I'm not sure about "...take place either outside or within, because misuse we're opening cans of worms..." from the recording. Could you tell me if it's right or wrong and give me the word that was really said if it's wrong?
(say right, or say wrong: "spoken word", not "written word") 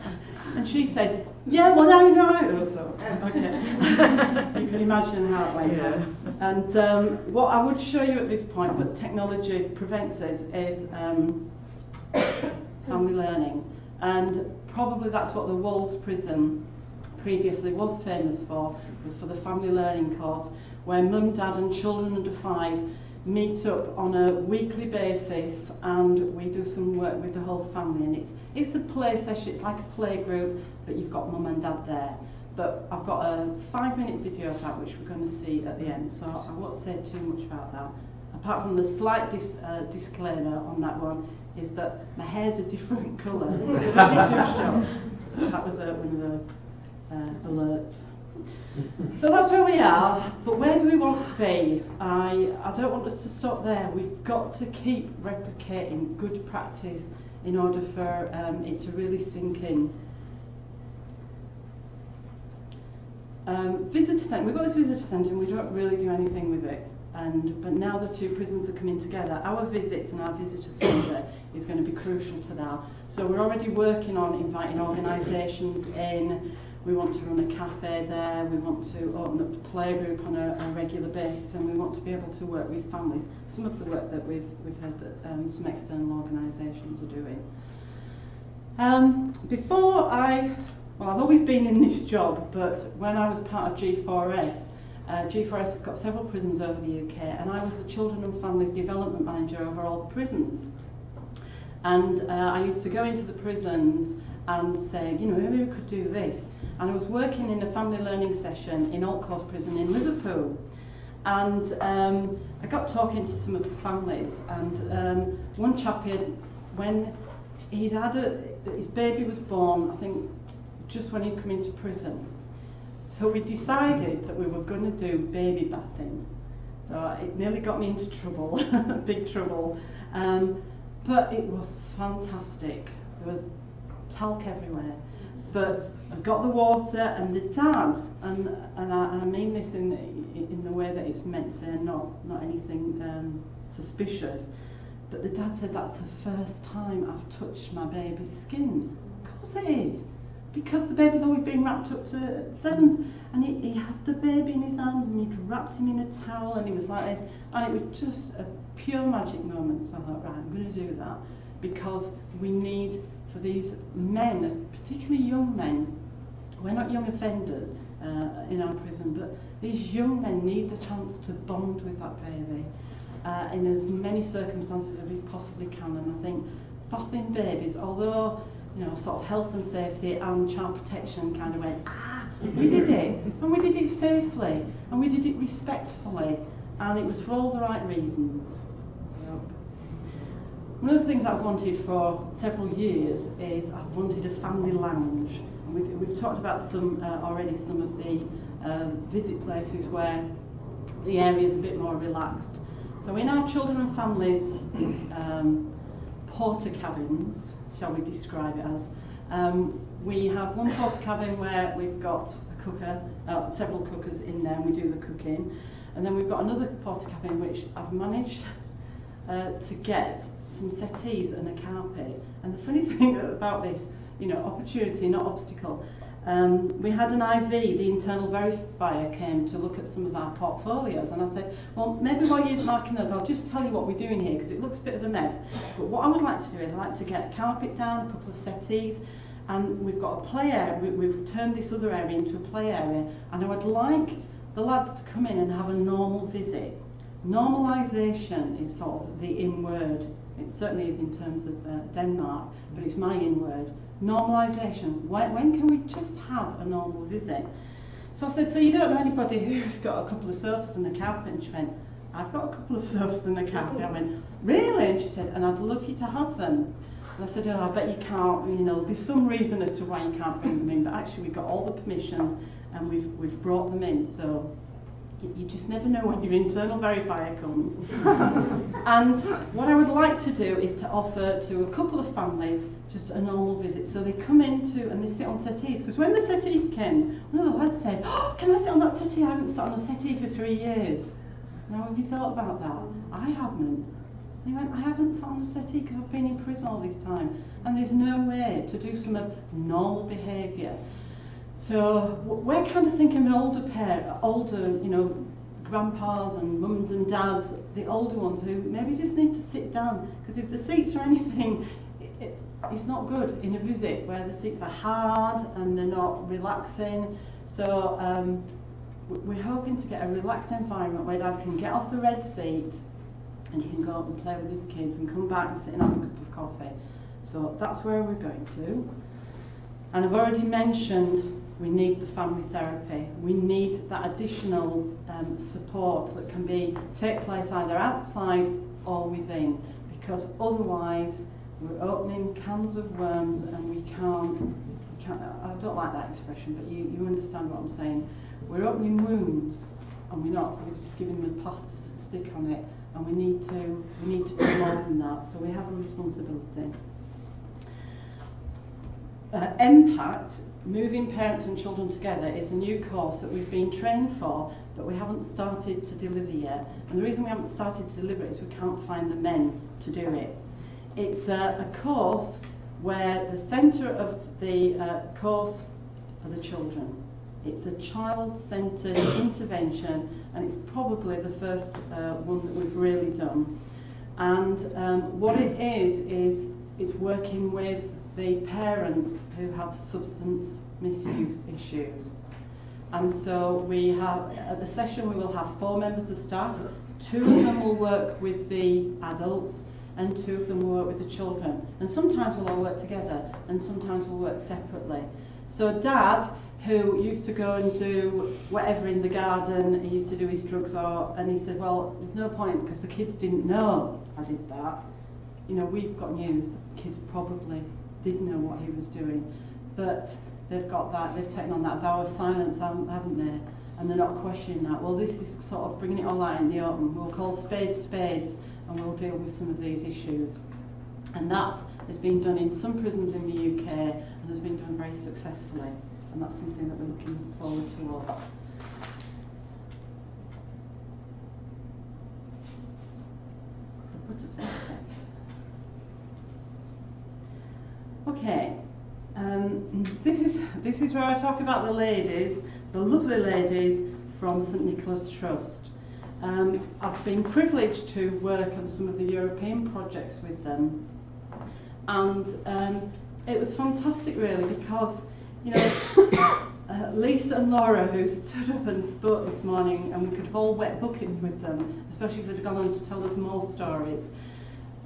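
wrong: "otherwise", not "misuse".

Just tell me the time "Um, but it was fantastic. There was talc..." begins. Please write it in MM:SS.
02:10.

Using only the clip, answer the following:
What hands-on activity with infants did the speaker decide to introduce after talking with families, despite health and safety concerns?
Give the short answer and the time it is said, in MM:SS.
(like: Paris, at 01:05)
Baby bathing, at 02:05.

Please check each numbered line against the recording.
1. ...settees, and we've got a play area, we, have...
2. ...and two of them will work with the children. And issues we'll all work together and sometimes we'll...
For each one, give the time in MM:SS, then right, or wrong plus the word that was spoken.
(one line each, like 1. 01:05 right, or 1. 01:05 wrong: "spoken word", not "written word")
1. 03:58 right
2. 06:39 wrong: "sometimes", not "issues".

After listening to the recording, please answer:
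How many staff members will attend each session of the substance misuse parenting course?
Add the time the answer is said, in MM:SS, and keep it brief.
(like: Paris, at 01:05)
4, at 06:35.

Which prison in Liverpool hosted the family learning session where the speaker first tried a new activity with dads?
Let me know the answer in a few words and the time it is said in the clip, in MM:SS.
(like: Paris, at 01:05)
Altcourse Prison, at 01:49.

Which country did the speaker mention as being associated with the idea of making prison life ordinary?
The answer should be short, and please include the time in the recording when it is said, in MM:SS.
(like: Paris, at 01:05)
Denmark, at 04:11.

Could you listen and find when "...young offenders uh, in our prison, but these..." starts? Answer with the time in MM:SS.
02:46.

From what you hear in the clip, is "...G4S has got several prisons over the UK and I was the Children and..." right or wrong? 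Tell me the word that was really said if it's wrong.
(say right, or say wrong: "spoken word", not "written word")
right.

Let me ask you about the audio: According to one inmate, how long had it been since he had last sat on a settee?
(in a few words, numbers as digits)
3 years.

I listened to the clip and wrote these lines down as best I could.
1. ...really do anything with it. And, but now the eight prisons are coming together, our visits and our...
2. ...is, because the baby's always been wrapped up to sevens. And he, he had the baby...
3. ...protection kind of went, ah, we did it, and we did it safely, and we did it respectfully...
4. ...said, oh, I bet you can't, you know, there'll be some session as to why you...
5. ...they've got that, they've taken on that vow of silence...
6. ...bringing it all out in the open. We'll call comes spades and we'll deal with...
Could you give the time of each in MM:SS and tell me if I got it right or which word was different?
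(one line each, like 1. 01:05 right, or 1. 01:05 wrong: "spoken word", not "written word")
1. 01:05 wrong: "two", not "eight"
2. 02:29 right
3. 03:00 right
4. 04:27 wrong: "reason", not "session"
5. 07:00 right
6. 07:05 wrong: "spades", not "comes".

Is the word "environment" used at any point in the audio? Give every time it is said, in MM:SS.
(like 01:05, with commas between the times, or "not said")
05:20.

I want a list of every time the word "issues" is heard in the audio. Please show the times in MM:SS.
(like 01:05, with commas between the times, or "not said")
06:31, 07:09.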